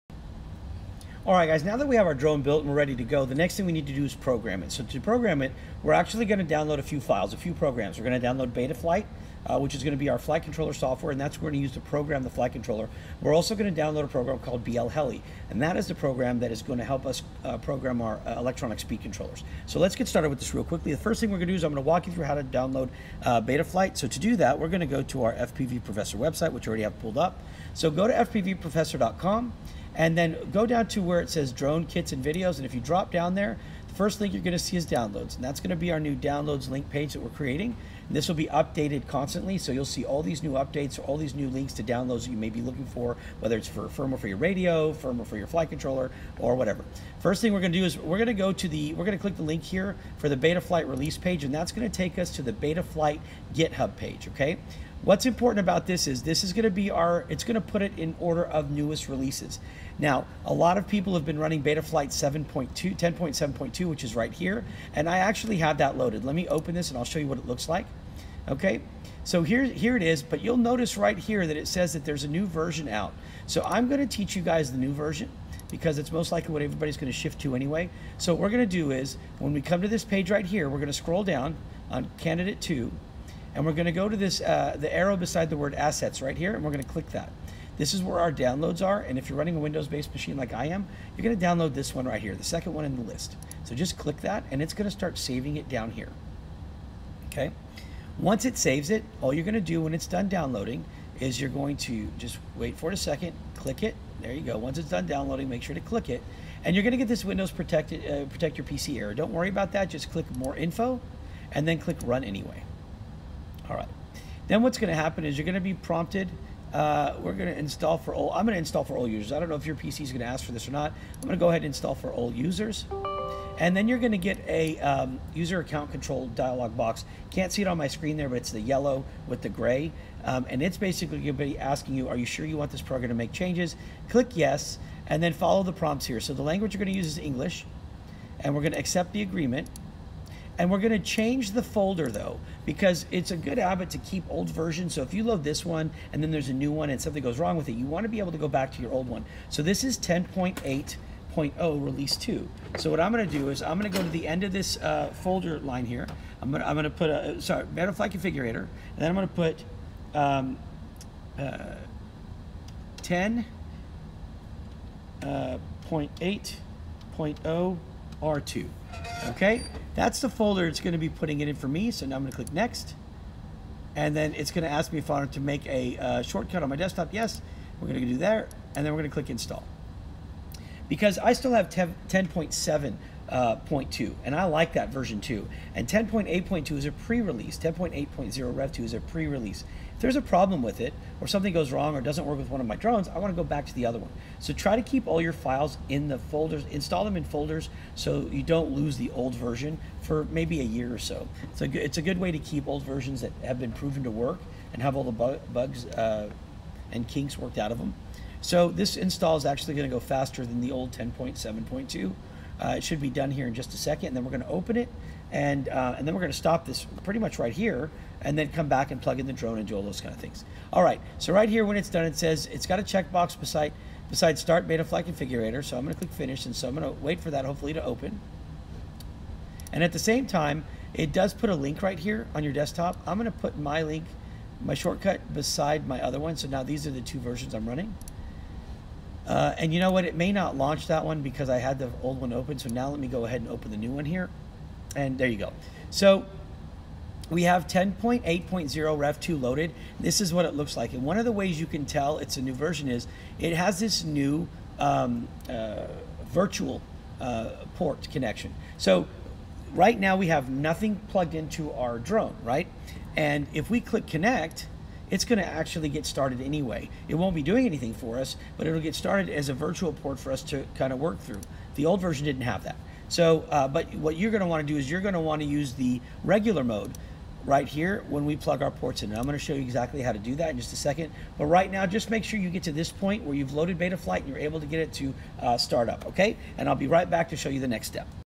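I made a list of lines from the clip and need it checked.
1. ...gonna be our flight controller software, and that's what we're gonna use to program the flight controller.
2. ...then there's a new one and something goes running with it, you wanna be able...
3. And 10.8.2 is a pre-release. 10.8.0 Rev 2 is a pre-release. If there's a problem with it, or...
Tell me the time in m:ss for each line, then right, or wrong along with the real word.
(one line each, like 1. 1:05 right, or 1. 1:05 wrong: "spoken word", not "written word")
1. 0:09 right
2. 2:26 wrong: "wrong", not "running"
3. 3:05 right.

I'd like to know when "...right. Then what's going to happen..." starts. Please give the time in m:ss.
1:53.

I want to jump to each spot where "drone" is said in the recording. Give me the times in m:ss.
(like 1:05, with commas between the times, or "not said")
0:02, 0:31, 3:12, 3:39, 4:21.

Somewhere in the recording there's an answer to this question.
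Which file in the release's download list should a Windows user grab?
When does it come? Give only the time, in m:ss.
1:32.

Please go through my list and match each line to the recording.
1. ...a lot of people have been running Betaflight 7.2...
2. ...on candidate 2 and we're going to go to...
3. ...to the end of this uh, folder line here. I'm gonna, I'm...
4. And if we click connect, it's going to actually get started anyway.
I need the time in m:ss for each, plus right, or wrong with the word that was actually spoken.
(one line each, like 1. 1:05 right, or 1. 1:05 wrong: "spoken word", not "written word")
1. 1:00 right
2. 1:21 right
3. 2:34 right
4. 4:23 right.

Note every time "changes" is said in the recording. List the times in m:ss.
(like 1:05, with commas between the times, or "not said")
2:13, 2:20.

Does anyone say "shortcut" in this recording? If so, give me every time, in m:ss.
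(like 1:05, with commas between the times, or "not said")
2:56, 3:54.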